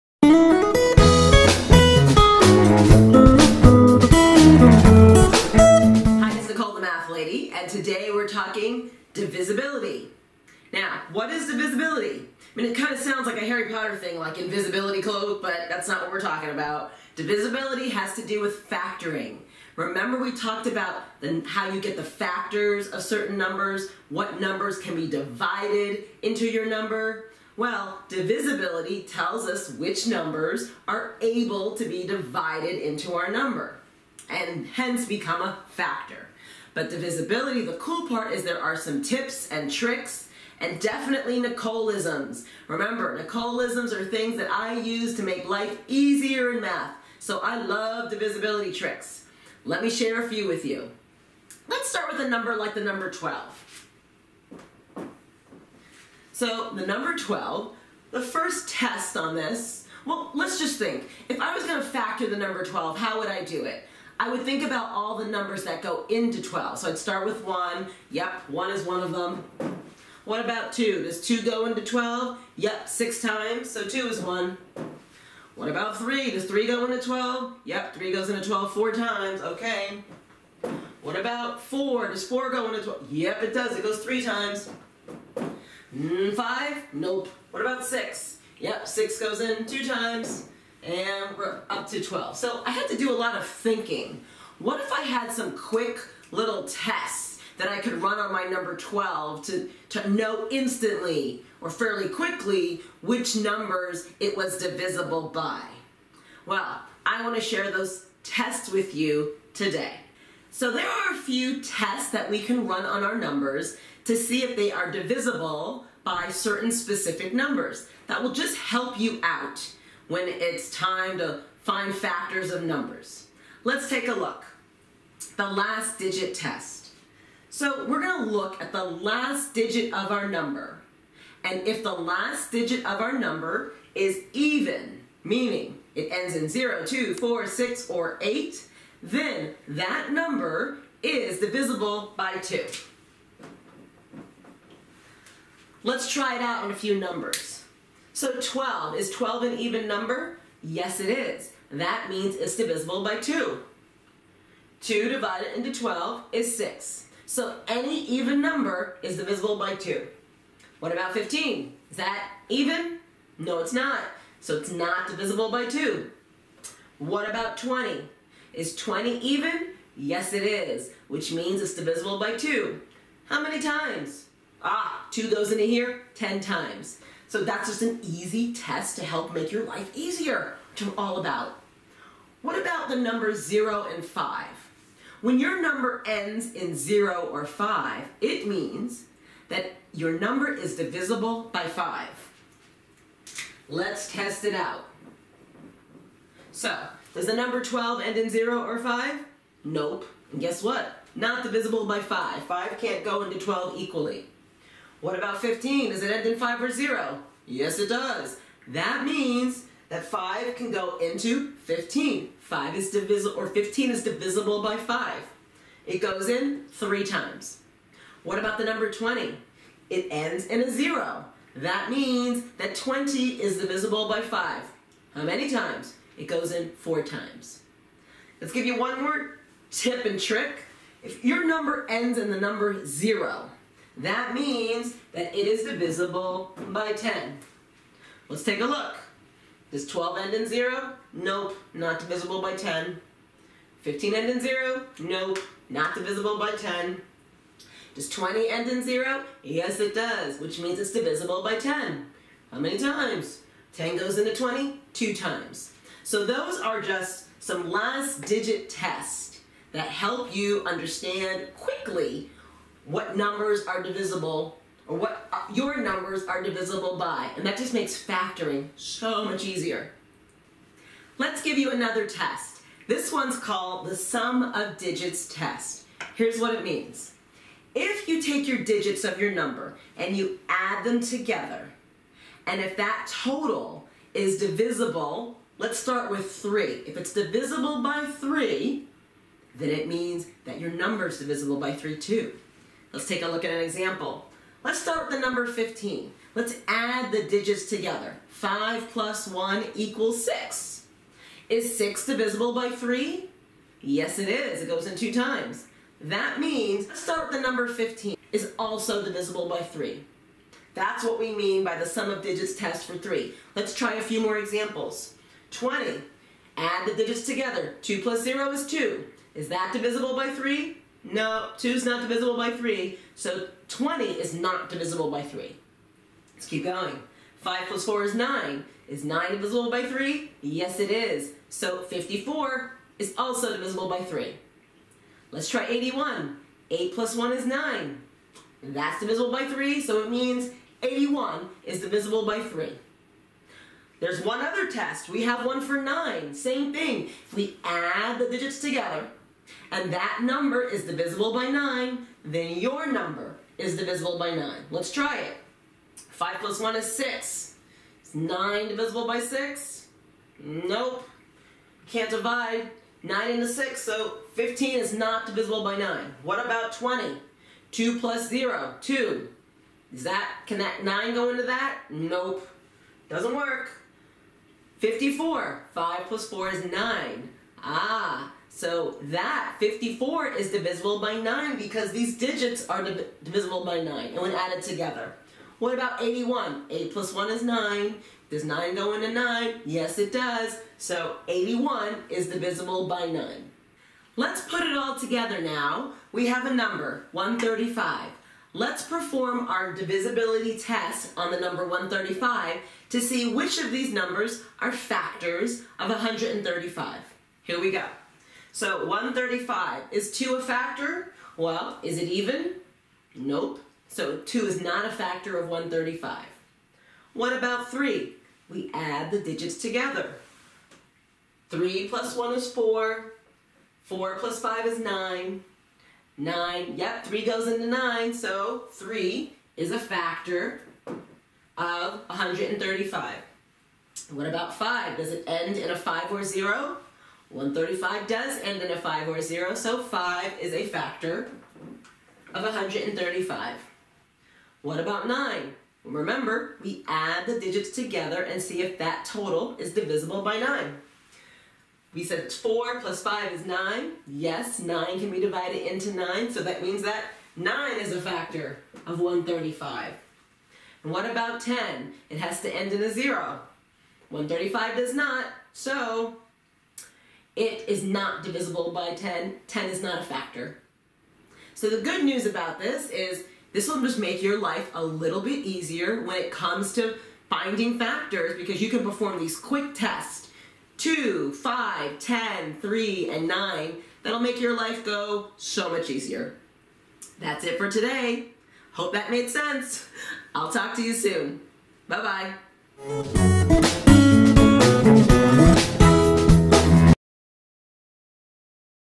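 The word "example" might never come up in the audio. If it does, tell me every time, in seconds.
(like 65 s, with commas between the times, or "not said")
293 s, 314 s.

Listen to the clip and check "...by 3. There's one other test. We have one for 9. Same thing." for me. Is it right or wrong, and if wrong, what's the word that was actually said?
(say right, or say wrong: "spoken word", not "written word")
right.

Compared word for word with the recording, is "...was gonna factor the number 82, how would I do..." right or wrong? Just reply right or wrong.
wrong.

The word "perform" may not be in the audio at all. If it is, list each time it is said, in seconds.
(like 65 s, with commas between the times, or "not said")
398 s, 478 s.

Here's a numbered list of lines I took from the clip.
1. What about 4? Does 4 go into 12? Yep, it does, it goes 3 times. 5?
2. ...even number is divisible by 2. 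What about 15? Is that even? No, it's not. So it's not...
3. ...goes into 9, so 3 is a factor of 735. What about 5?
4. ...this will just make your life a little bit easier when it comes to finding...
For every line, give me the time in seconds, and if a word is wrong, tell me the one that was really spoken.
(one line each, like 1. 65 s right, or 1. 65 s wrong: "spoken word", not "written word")
1. 81 s right
2. 158 s right
3. 427 s wrong: "135", not "735"
4. 473 s right.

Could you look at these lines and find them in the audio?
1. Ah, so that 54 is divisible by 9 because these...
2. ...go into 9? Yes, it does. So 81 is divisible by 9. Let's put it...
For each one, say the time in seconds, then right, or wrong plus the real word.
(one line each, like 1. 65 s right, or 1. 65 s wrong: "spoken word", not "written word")
1. 377 s right
2. 388 s right.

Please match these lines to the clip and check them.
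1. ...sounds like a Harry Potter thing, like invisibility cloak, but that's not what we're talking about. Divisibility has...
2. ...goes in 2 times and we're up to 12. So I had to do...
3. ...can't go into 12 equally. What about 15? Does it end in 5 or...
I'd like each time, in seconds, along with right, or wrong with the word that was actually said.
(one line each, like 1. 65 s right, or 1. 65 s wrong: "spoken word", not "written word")
1. 12 s right
2. 89 s right
3. 202 s right.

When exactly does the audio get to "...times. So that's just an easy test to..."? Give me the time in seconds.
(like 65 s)
176 s.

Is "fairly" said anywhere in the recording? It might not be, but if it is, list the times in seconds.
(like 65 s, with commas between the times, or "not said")
101 s.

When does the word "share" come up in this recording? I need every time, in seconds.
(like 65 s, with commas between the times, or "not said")
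49 s, 107 s.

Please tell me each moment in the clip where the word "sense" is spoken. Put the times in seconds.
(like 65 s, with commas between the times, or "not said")
489 s.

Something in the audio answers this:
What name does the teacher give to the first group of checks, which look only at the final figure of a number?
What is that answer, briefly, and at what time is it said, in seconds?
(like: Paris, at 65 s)
The last digit test, at 125 s.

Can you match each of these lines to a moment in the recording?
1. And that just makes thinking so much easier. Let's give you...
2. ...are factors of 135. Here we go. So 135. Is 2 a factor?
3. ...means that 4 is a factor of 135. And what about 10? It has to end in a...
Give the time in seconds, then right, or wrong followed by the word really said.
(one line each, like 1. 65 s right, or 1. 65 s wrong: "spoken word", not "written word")
1. 267 s wrong: "factoring", not "thinking"
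2. 404 s right
3. 456 s wrong: "9", not "4".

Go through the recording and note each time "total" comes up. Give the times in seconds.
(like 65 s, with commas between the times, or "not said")
283 s, 449 s.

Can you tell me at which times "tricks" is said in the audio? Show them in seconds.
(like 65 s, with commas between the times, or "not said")
39 s, 48 s, 230 s.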